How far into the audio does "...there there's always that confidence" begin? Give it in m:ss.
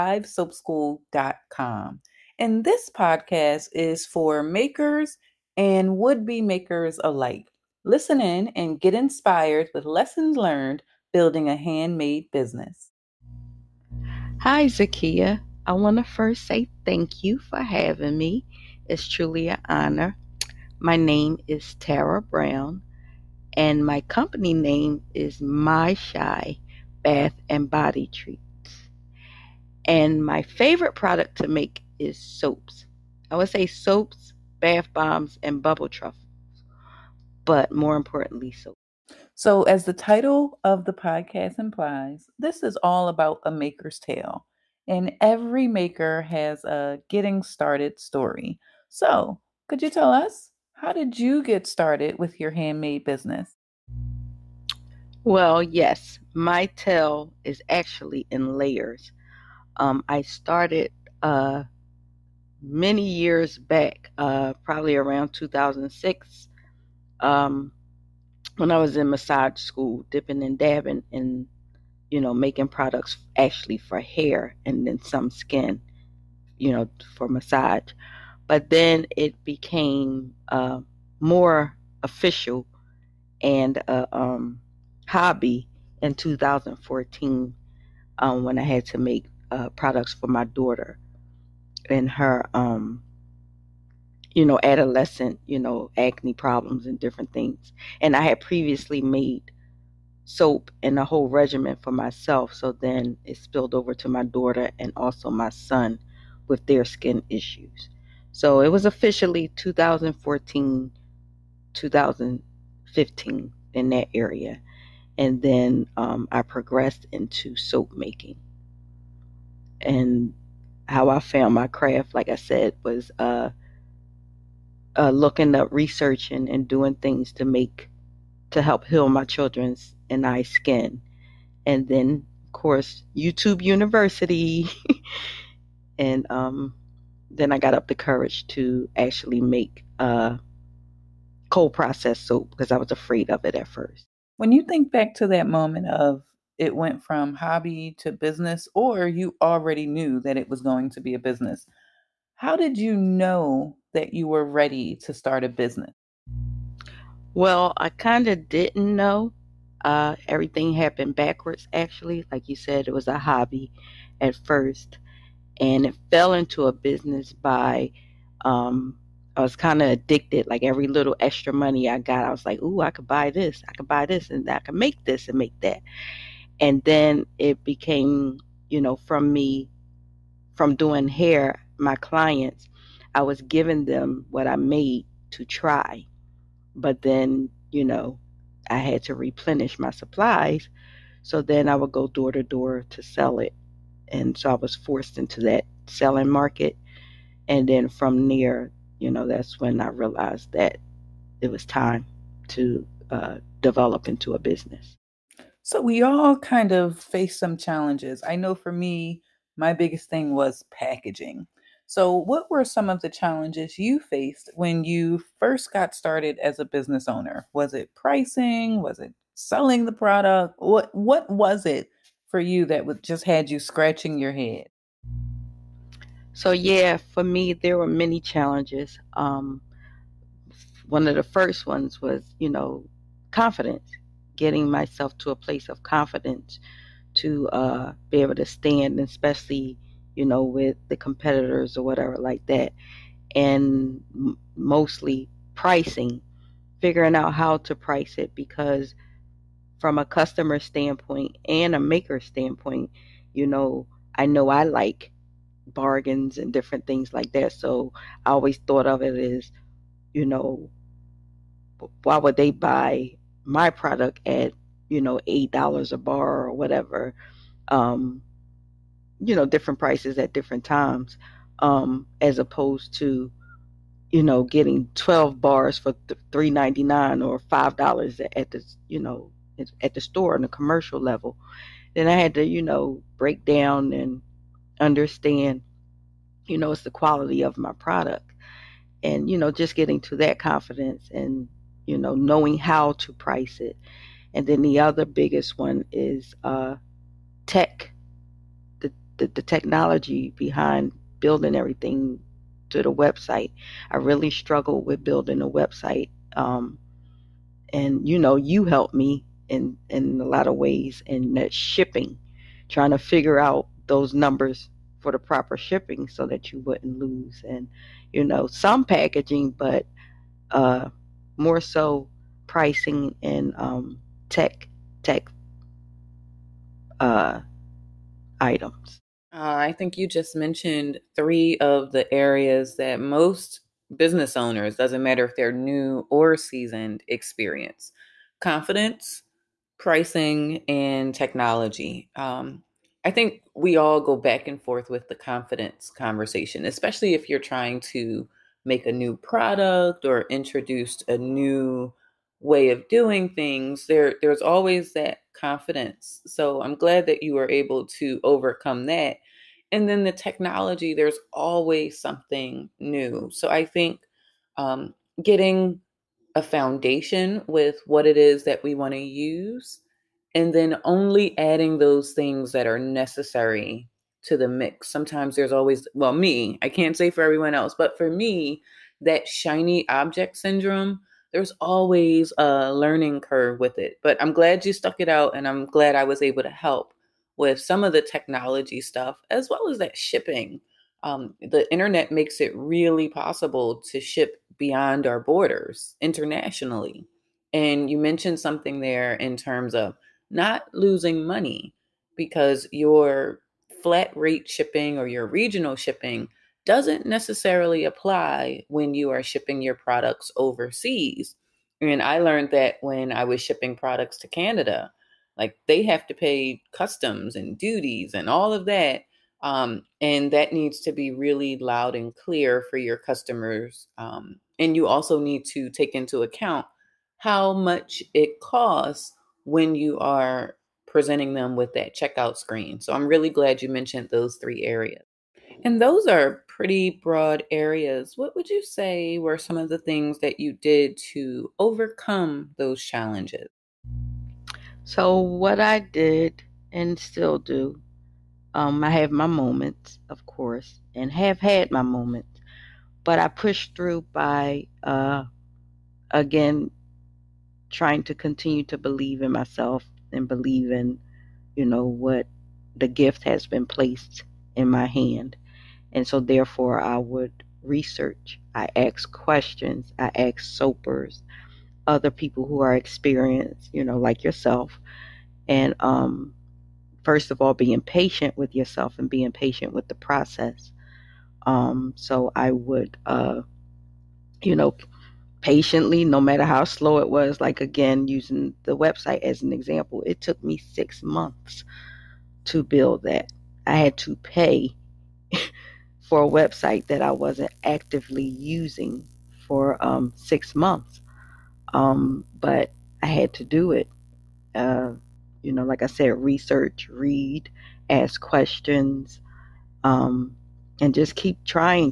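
5:53.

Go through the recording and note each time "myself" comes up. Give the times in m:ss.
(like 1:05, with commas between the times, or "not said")
1:41, 3:54, 7:39.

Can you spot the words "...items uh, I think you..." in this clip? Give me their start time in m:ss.
5:28.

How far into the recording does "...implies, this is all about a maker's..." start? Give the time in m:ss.
0:41.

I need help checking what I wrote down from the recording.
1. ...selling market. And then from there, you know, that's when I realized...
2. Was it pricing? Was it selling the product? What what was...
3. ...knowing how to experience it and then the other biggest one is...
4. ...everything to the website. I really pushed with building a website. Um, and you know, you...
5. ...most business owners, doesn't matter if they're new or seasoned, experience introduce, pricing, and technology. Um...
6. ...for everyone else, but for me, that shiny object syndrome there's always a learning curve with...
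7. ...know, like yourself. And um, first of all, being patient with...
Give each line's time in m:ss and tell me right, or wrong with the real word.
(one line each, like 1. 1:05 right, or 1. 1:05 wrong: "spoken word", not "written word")
1. 3:15 right
2. 3:37 right
3. 4:52 wrong: "price", not "experience"
4. 5:01 wrong: "struggled", not "pushed"
5. 5:32 wrong: "confidence", not "introduce"
6. 6:17 right
7. 7:53 right.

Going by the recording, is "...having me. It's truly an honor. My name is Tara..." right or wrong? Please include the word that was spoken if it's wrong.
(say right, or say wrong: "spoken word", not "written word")
right.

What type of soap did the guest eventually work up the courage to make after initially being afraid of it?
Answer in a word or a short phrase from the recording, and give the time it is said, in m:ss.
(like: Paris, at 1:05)
Cold processed soap, at 2:21.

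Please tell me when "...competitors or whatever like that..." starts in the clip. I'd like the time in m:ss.
4:00.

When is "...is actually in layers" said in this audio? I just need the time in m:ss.
0:57.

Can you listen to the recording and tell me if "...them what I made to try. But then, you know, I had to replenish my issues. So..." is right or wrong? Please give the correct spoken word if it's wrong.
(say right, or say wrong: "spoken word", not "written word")
wrong: "supplies", not "issues".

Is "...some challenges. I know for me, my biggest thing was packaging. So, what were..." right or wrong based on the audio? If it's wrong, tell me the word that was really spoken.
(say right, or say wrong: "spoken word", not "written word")
right.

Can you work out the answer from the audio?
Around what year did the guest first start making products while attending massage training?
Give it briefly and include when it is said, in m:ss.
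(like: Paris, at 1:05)
2006, at 1:05.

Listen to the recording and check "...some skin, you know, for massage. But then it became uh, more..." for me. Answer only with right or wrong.
right.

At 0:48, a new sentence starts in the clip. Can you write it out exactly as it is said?
So, could you tell us how did you get started with your handmade business?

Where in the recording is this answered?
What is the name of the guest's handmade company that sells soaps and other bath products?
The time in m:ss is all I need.
0:25.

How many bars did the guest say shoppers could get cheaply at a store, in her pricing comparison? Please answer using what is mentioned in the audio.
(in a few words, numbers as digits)
12.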